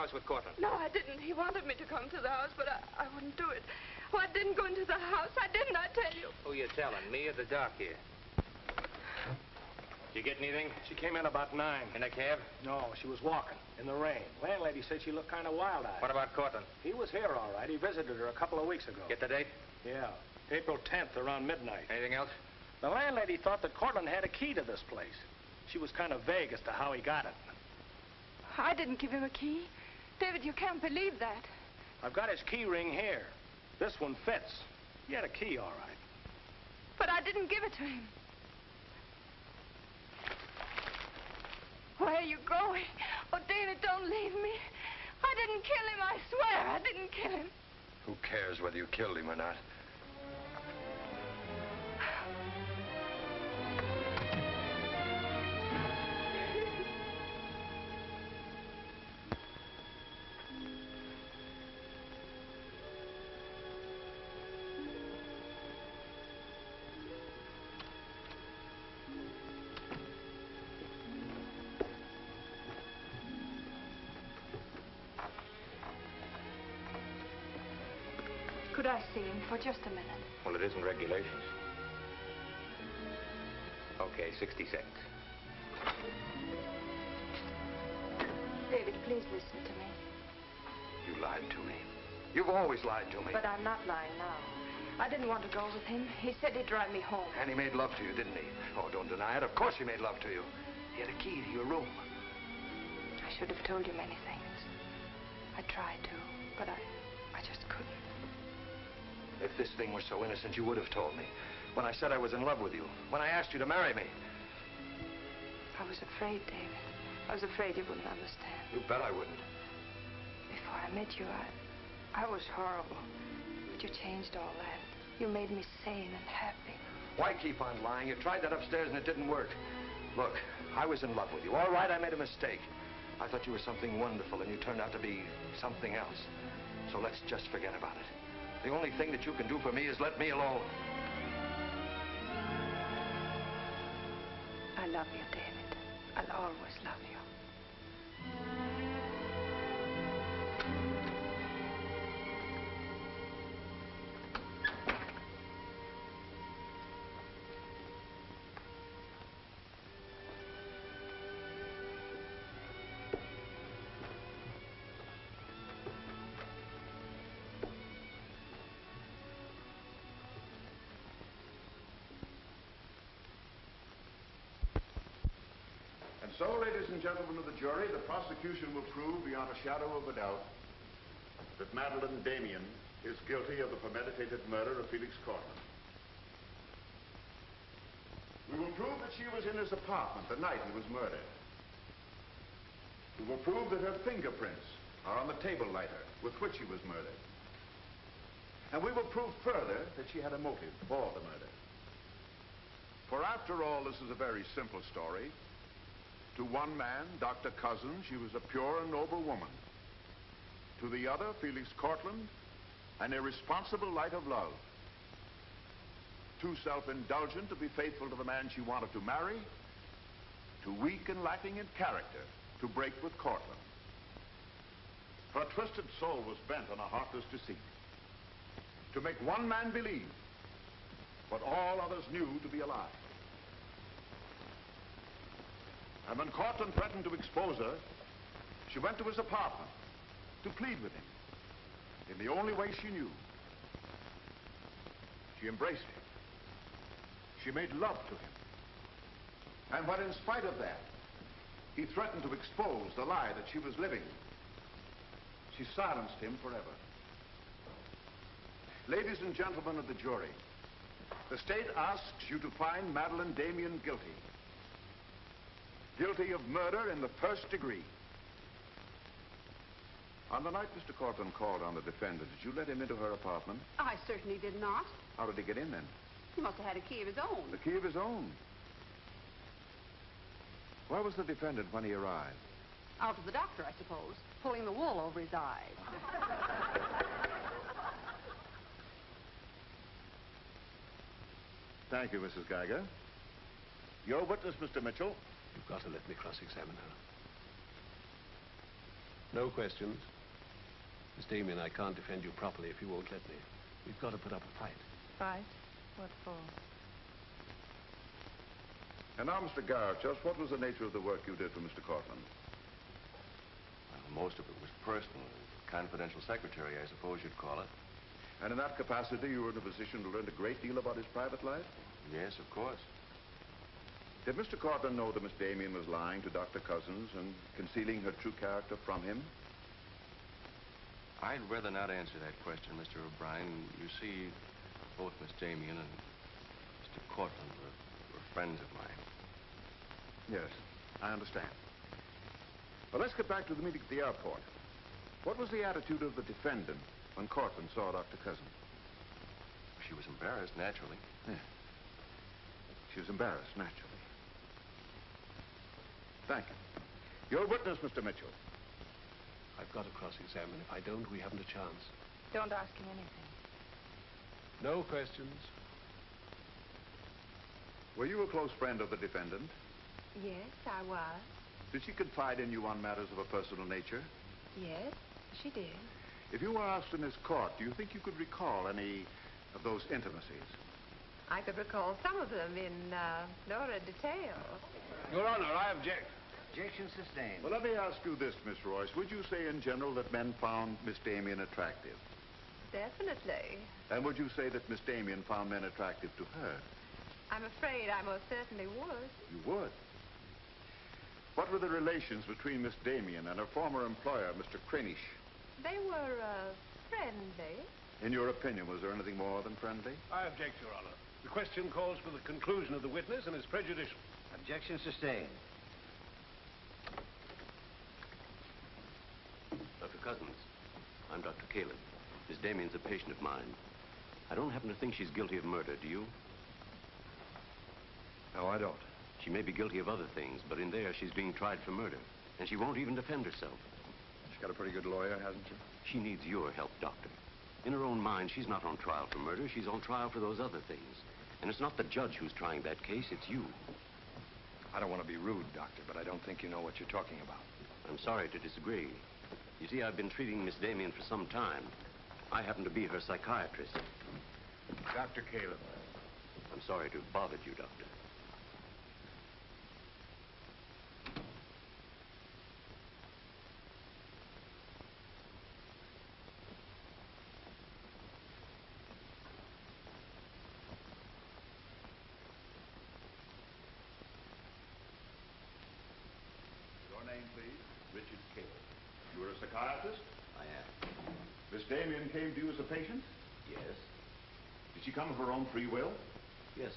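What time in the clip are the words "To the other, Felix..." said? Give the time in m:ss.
3:30.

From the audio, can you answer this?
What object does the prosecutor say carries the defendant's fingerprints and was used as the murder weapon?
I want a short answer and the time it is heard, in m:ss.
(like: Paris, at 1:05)
table lighter, at 3:15.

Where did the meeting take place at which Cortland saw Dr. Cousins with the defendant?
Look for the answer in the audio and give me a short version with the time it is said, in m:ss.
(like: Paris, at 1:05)
the airport, at 5:43.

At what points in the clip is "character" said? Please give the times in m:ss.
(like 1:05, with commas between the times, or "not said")
3:41, 5:28.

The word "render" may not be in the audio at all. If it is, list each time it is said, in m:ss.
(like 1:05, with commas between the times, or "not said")
not said.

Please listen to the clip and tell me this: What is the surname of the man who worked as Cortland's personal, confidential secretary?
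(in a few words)
Garrett.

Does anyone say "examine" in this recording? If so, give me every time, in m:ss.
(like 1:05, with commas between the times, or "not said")
4:56, 5:59.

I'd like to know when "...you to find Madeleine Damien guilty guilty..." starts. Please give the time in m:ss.
4:22.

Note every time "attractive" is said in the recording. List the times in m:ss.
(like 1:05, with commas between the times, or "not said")
6:31, 6:35.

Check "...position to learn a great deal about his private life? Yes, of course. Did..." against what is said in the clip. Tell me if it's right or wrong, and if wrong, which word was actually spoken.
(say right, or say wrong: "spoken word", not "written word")
right.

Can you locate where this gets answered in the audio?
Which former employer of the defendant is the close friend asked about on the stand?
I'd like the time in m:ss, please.
6:44.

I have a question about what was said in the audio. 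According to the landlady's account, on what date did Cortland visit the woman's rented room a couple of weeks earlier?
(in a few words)
April 10th.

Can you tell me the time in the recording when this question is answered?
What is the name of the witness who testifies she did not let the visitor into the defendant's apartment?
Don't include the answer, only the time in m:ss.
4:52.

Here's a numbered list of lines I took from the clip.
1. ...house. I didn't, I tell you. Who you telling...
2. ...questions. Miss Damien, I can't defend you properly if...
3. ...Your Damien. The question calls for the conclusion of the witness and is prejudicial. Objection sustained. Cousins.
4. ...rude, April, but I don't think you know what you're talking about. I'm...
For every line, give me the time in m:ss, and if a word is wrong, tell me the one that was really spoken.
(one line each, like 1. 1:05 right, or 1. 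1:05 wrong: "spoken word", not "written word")
1. 0:04 right
2. 4:59 right
3. 6:50 wrong: "Honor", not "Damien"
4. 7:25 wrong: "Doctor", not "April".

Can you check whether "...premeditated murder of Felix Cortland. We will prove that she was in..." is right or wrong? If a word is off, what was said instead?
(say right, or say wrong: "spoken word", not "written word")
right.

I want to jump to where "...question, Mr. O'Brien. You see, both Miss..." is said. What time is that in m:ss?
5:32.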